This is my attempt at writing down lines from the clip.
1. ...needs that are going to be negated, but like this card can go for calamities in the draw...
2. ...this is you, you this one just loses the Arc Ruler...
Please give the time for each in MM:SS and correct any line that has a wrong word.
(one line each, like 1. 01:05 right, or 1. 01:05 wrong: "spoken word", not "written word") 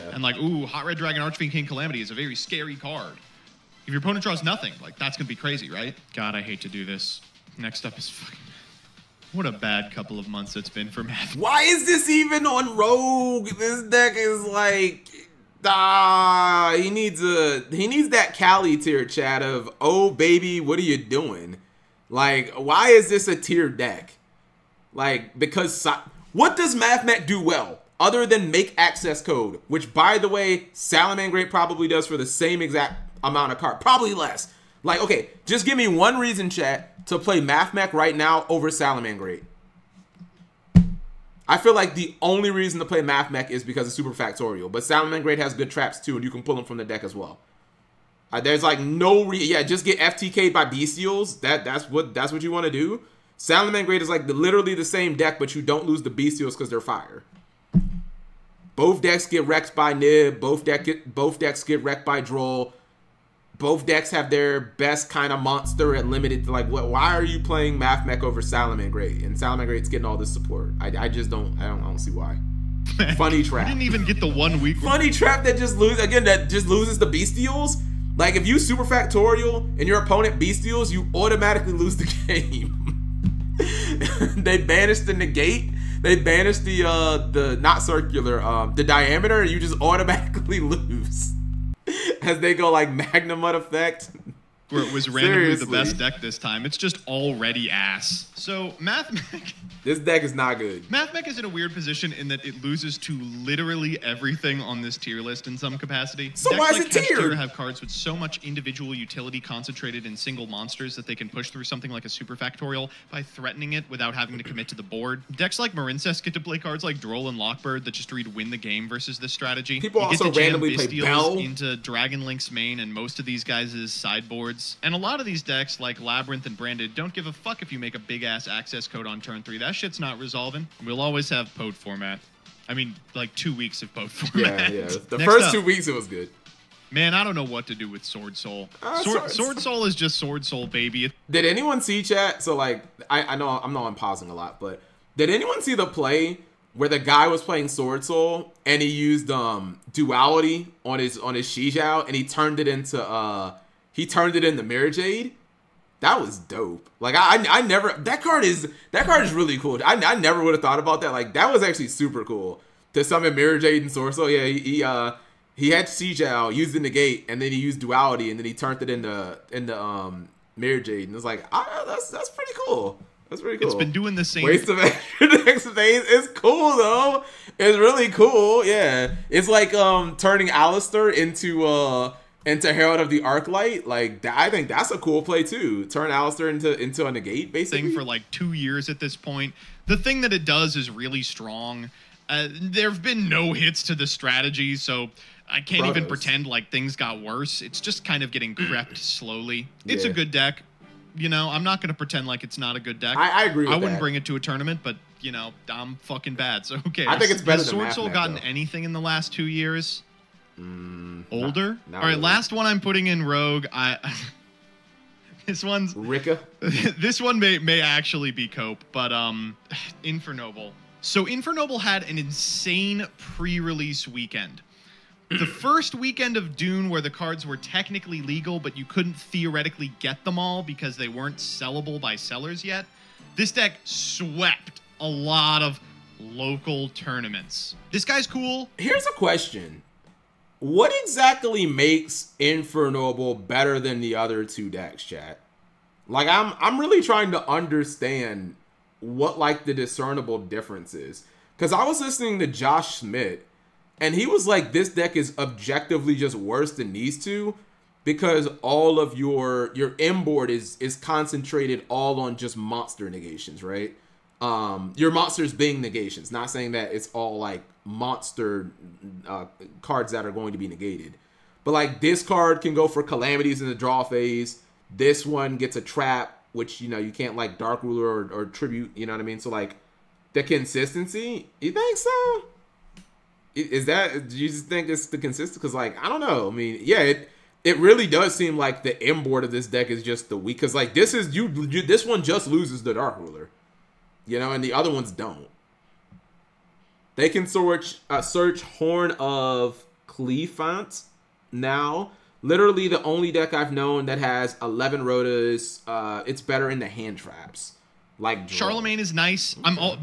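1. 04:29 wrong: "cards", not "needs"
2. 04:50 wrong: "Dark", not "Arc".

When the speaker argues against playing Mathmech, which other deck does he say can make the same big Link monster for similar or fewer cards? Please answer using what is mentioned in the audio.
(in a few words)
Salamangreat.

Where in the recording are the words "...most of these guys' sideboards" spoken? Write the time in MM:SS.
02:02.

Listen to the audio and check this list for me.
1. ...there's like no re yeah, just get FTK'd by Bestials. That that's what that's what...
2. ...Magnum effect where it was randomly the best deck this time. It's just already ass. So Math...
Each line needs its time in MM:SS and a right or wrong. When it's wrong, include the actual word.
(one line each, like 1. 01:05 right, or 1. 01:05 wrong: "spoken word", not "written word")
1. 00:48 right
2. 01:32 right.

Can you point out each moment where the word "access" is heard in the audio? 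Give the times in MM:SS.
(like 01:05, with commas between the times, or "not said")
00:28, 02:08.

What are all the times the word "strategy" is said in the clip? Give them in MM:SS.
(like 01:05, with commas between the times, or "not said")
01:59, 03:14.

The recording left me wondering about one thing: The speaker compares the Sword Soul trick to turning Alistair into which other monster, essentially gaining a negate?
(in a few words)
Herald of the Arc Light.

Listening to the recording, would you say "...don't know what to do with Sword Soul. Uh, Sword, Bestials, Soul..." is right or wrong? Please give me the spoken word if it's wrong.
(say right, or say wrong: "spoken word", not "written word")
wrong: "Sword", not "Bestials".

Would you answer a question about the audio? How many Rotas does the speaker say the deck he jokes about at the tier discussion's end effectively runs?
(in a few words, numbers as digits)
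11.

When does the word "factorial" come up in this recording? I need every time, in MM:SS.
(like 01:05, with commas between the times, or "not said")
00:44, 01:18, 01:52.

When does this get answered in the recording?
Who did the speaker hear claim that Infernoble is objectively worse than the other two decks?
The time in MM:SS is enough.
04:12.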